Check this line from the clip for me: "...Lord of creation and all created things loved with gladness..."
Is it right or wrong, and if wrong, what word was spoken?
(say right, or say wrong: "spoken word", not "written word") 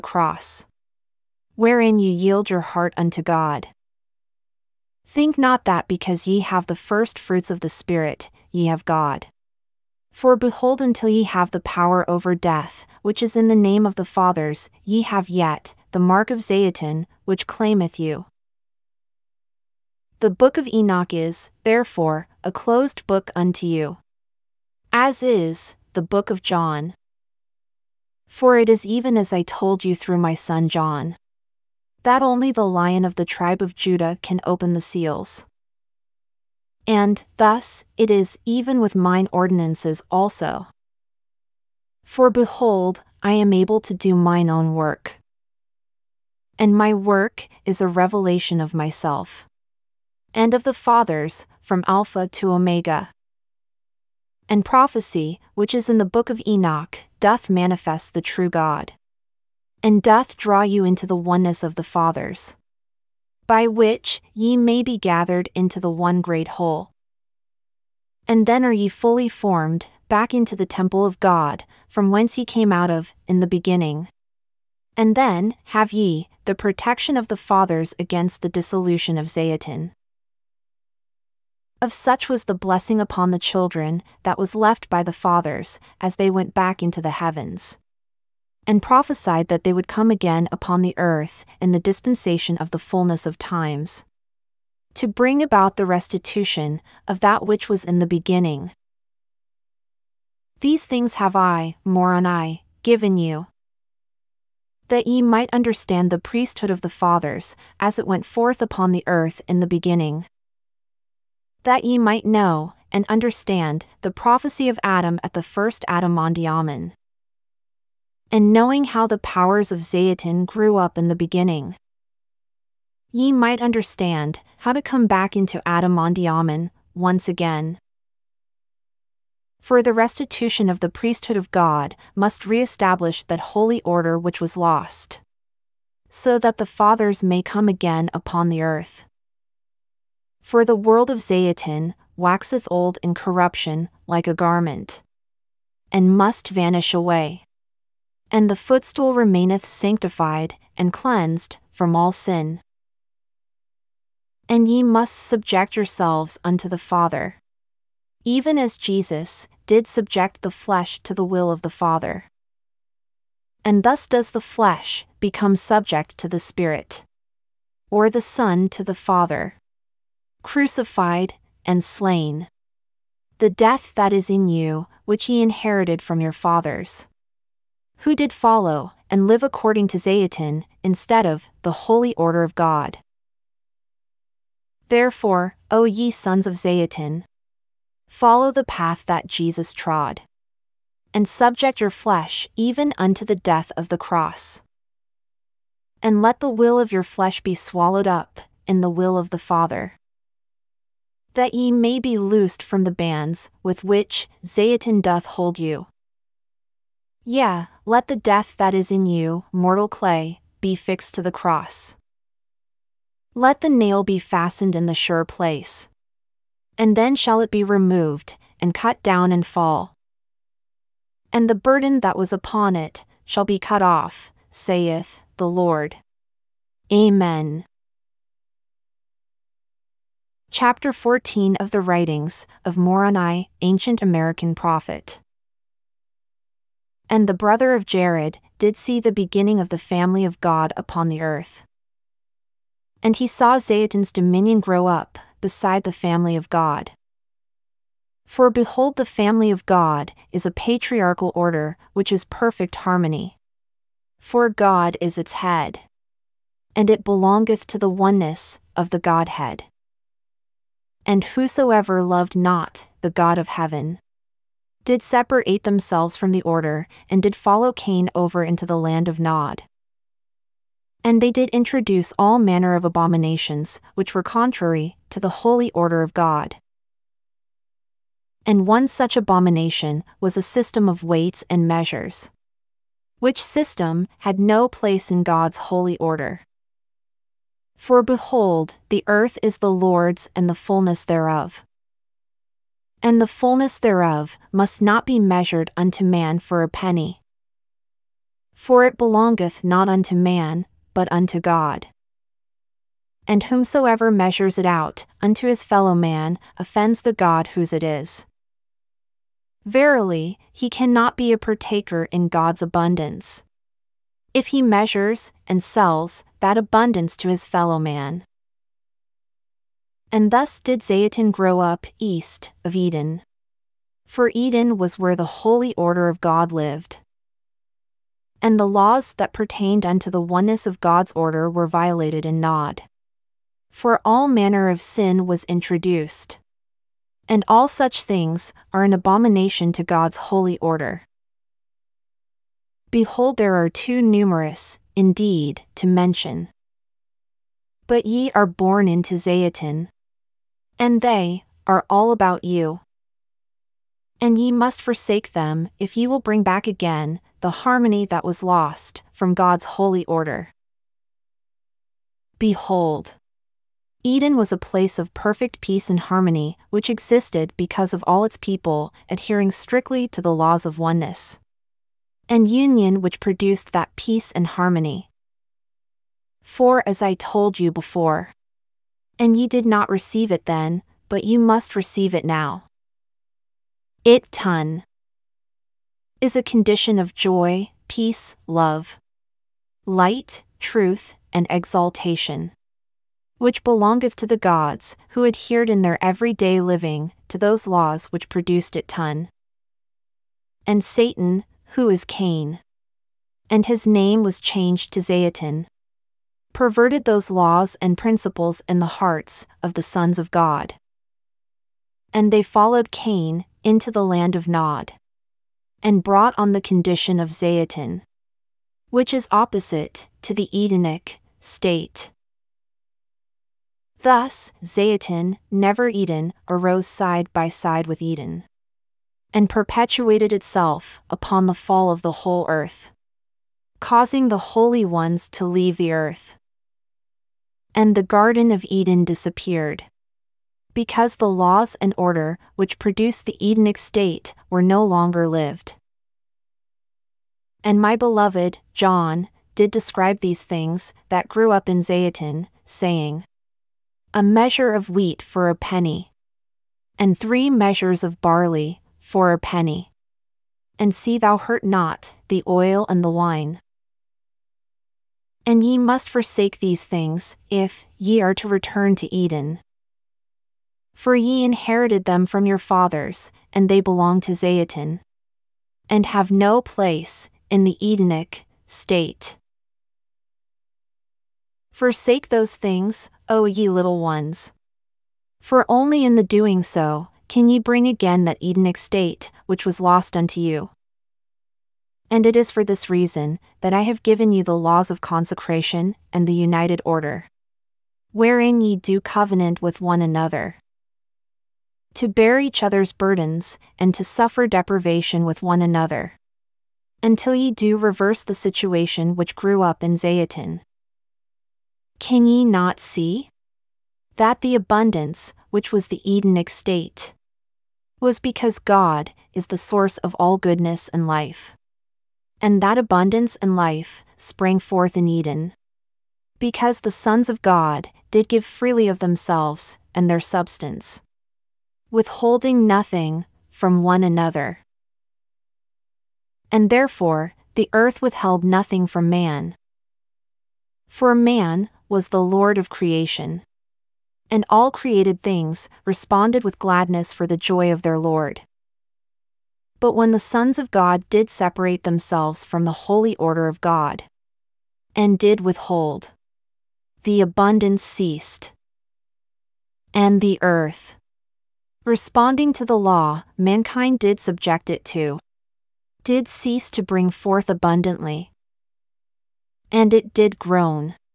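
wrong: "responded", not "loved".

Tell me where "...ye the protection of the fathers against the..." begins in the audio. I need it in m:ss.
1:15.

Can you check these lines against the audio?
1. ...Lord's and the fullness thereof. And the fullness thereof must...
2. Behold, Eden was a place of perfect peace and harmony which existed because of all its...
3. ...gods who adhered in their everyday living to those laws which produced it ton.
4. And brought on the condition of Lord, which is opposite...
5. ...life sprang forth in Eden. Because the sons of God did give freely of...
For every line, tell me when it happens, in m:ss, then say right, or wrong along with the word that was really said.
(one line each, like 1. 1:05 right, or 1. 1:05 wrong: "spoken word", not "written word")
1. 4:49 right
2. 6:02 right
3. 6:34 right
4. 6:55 wrong: "Zayatin", not "Lord"
5. 8:43 right.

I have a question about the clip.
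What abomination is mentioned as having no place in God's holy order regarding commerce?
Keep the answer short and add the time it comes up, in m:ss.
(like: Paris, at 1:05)
A system of weights and measures, at 4:40.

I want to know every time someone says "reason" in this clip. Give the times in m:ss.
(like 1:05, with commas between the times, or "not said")
8:12.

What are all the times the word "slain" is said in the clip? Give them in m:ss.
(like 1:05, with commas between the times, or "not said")
2:51.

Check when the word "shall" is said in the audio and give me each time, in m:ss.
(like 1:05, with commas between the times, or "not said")
3:37, 3:43.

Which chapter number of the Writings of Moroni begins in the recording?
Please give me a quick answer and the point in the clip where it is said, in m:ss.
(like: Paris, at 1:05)
14, at 3:50.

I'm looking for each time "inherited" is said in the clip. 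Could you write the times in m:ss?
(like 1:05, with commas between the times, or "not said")
2:55, 7:51.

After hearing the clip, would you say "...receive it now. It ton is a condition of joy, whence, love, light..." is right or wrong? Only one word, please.
wrong.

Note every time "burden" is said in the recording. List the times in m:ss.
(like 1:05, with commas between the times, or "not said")
3:41, 8:22.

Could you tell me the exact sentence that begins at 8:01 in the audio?
Forsake those things, O ye little ones.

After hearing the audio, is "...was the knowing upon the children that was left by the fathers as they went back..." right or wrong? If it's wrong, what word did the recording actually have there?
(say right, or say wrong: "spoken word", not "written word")
wrong: "blessing", not "knowing".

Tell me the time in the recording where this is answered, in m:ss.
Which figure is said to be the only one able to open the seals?
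0:32.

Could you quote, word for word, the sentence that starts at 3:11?
And subject your flesh even unto the death of the cross.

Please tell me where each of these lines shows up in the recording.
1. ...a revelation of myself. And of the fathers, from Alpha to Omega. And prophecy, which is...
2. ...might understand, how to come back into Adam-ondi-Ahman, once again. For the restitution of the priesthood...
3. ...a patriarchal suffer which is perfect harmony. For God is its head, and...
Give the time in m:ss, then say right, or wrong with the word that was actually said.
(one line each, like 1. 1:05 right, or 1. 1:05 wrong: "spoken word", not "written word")
1. 0:47 right
2. 2:03 right
3. 4:10 wrong: "order", not "suffer".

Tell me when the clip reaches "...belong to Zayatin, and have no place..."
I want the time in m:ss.
7:53.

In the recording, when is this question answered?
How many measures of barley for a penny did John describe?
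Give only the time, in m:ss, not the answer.
7:37.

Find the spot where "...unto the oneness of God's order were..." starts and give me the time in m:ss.
5:29.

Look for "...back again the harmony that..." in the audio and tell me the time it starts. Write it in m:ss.
5:56.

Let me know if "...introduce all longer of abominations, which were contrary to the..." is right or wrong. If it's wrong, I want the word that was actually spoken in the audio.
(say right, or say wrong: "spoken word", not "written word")
wrong: "manner", not "longer".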